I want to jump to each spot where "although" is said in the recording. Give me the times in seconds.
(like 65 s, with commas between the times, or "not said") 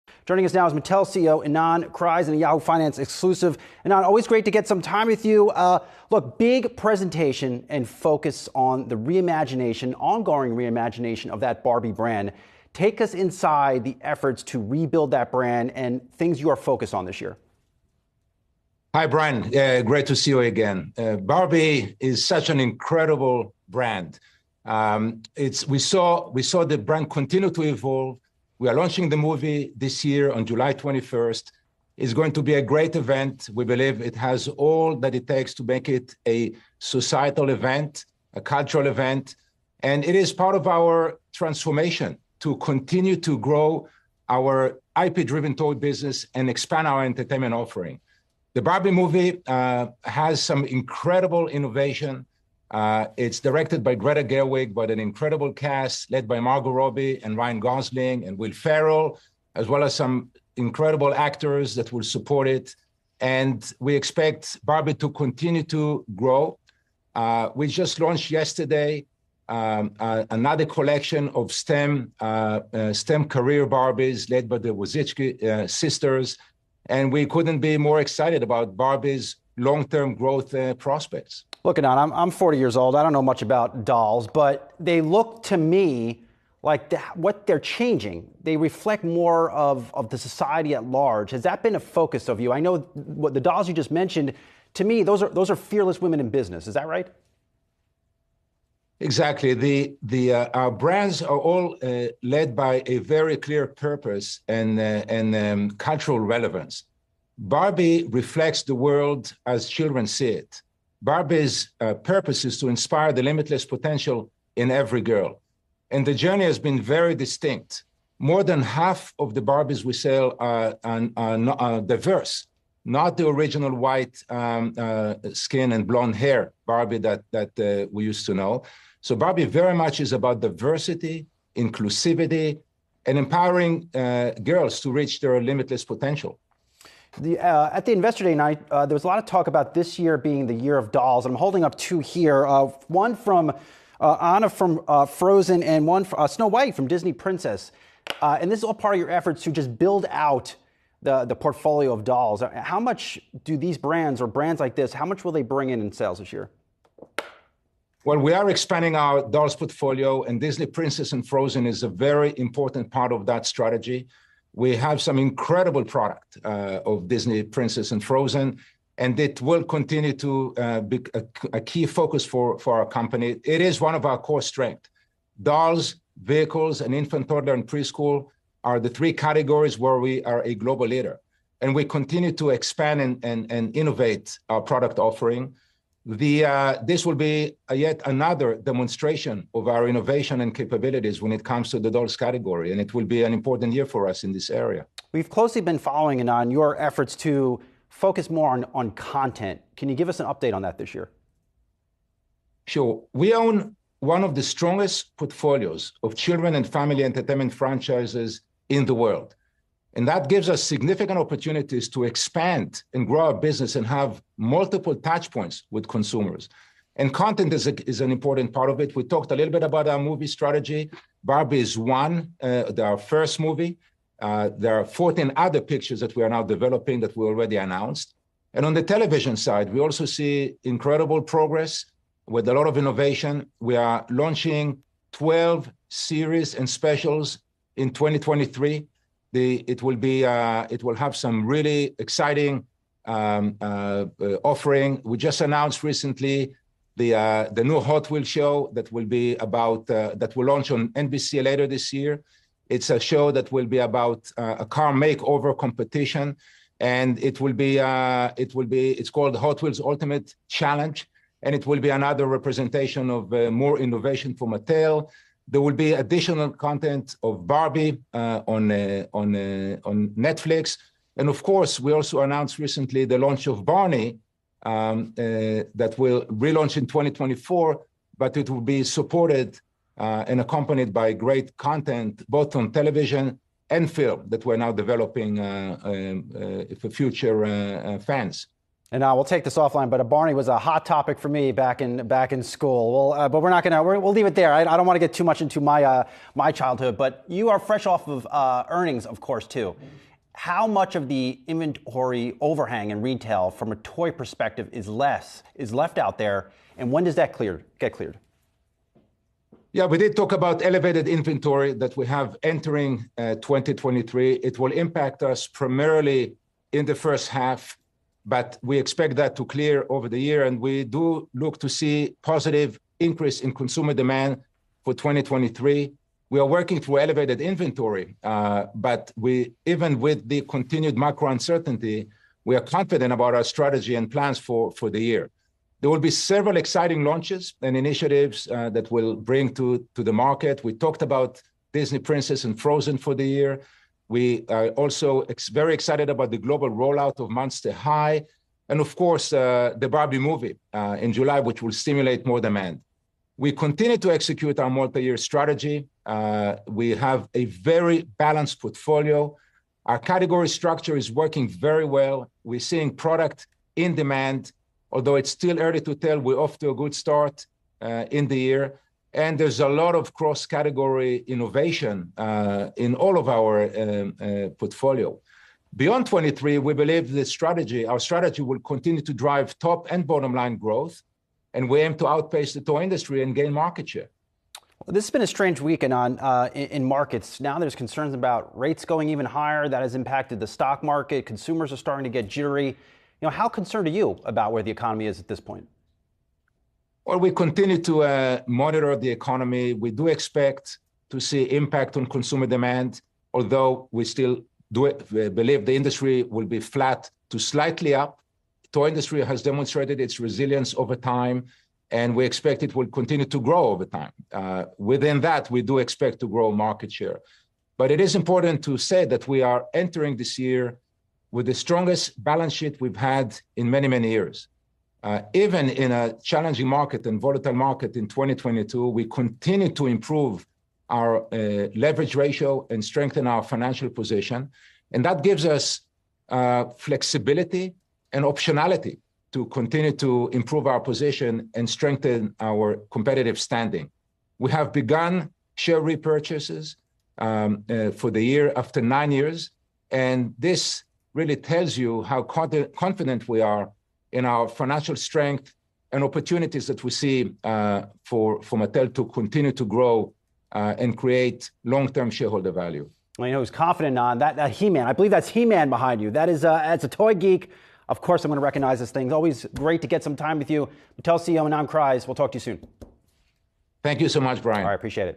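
364 s, 403 s.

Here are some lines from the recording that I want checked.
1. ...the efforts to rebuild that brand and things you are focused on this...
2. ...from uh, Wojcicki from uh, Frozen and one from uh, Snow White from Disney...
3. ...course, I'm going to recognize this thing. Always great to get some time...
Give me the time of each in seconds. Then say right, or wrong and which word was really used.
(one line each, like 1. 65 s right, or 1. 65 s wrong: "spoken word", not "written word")
1. 13 s right
2. 143 s wrong: "Anna", not "Wojcicki"
3. 467 s right.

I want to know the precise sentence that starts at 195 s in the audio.
We've closely been following and on your efforts to focus more on, on content.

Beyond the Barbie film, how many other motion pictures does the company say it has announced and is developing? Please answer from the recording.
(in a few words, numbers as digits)
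14.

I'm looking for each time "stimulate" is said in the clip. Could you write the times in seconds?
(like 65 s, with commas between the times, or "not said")
351 s.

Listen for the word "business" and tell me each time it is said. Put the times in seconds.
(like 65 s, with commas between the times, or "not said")
45 s, 96 s, 213 s.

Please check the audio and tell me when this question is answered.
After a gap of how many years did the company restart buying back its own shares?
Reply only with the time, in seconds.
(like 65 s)
448 s.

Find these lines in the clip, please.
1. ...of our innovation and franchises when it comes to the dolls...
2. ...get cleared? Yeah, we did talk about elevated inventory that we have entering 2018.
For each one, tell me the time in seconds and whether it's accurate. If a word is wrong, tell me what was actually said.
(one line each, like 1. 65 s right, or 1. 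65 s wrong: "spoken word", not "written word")
1. 189 s wrong: "capabilities", not "franchises"
2. 307 s wrong: "2023", not "2018".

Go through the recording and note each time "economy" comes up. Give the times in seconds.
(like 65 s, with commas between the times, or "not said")
394 s, 399 s.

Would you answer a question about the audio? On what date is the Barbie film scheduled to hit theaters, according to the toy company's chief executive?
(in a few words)
July 21st.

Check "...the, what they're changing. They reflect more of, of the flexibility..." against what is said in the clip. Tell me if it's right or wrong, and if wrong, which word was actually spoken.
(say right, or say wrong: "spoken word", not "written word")
wrong: "society", not "flexibility".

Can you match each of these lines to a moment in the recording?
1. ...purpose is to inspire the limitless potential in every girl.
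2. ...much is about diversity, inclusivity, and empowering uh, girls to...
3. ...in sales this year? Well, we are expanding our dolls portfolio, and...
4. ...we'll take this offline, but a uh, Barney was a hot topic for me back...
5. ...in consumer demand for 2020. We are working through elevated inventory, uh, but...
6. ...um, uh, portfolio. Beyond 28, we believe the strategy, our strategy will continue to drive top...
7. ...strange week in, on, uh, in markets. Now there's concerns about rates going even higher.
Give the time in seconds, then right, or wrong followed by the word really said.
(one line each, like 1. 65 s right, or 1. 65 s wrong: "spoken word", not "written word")
1. 111 s right
2. 129 s right
3. 155 s right
4. 289 s right
5. 323 s wrong: "2023", not "2020"
6. 373 s wrong: "23", not "28"
7. 385 s right.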